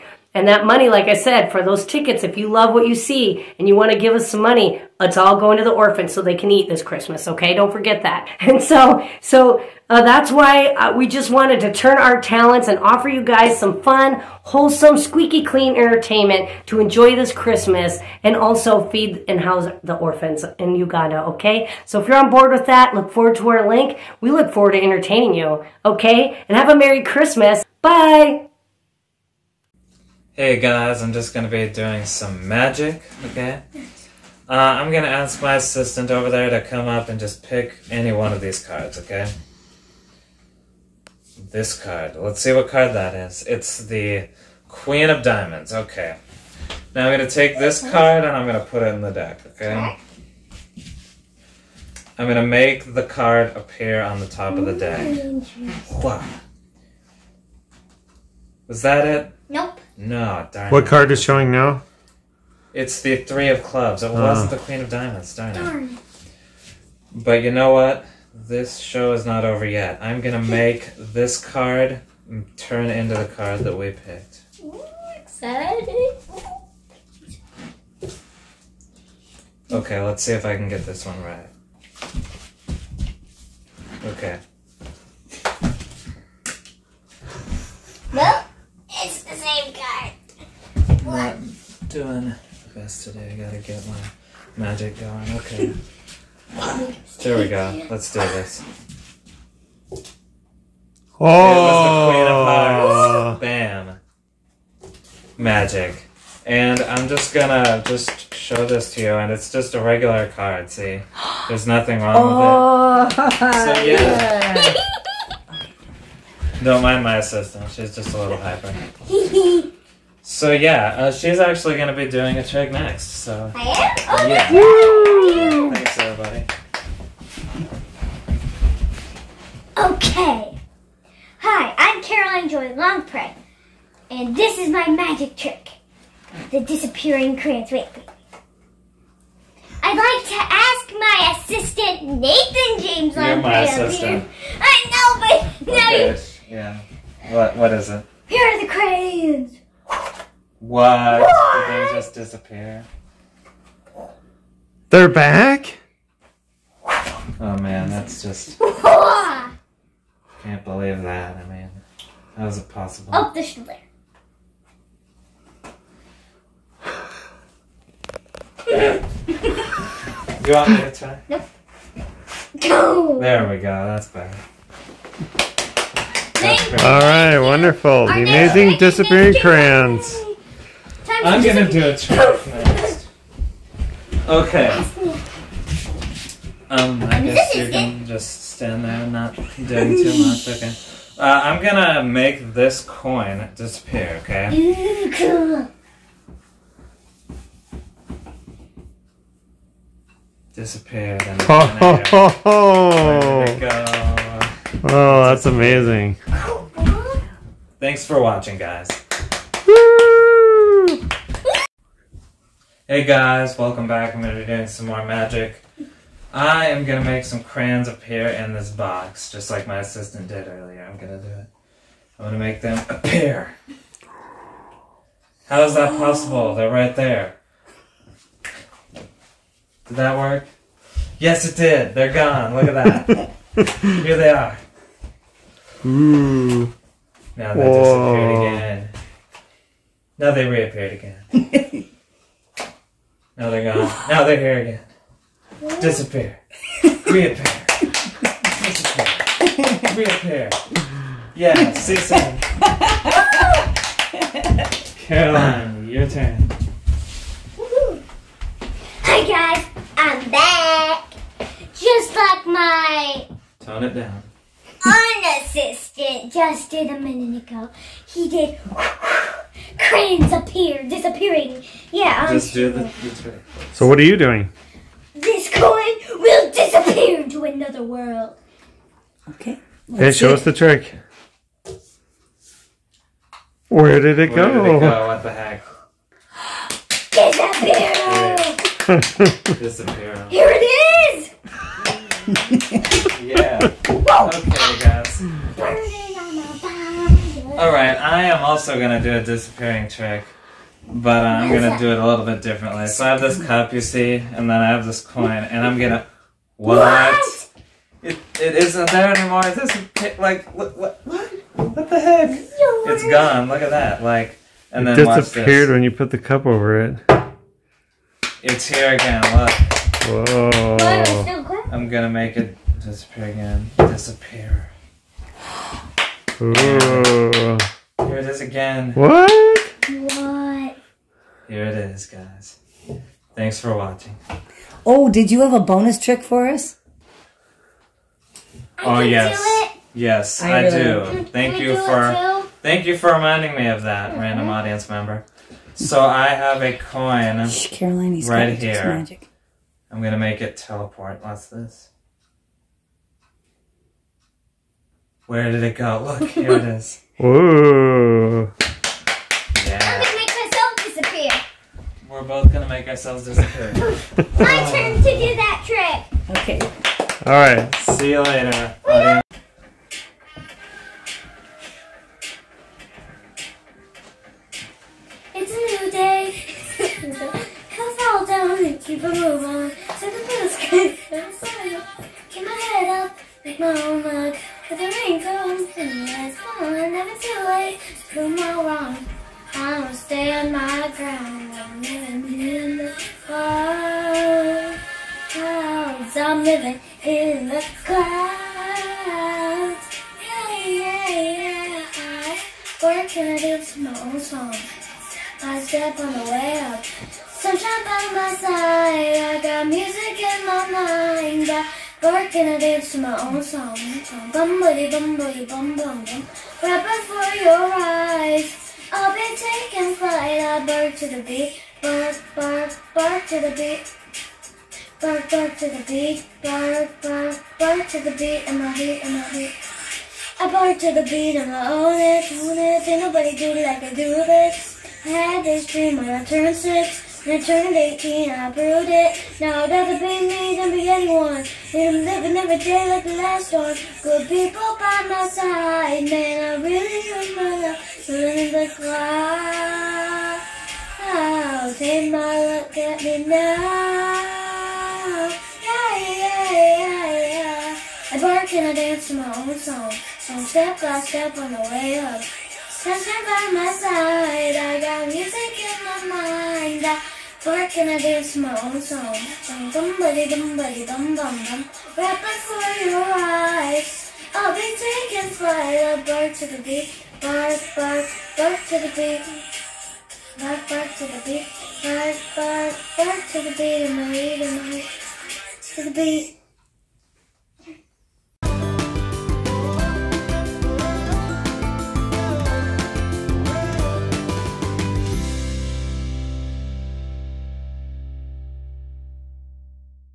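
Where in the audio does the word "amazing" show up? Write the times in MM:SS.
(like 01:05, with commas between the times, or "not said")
02:58, 03:25.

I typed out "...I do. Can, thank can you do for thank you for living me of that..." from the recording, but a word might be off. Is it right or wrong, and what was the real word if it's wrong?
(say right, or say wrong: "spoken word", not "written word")
wrong: "reminding", not "living".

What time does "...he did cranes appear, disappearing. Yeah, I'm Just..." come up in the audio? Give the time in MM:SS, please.
04:28.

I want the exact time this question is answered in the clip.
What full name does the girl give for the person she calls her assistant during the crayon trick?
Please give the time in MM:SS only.
02:22.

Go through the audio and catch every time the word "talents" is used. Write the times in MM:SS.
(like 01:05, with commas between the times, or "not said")
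00:12.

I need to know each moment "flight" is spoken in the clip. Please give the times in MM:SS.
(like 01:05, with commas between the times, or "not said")
06:59, 07:55.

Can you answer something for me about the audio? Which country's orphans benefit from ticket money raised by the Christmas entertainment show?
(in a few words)
Uganda.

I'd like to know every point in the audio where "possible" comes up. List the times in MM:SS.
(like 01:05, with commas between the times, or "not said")
02:42, 03:45.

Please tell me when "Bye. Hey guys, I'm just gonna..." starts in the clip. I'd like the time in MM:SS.
00:27.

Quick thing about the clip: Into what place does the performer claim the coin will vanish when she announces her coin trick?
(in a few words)
Another world.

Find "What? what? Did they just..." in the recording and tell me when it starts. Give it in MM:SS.
02:30.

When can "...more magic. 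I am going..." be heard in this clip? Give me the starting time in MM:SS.
03:34.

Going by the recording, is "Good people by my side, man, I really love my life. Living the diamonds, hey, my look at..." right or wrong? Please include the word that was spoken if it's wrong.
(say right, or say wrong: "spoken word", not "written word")
wrong: "clouds", not "diamonds".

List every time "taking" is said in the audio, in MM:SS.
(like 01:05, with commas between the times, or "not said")
06:59, 07:54.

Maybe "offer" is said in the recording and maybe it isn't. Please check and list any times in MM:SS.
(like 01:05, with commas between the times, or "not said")
00:12.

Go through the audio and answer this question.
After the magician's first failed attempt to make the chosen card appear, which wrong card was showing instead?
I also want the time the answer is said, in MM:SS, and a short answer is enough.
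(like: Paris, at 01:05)
Three of clubs, at 01:03.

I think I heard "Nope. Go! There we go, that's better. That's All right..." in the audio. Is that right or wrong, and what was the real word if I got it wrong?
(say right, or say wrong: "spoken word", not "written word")
right.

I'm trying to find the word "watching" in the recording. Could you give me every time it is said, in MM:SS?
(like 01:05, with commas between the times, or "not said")
03:28, 05:33.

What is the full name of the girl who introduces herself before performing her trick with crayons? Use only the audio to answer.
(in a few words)
Caroline Joy Longpre.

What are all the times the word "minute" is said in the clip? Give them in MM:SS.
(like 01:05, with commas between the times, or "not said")
04:27.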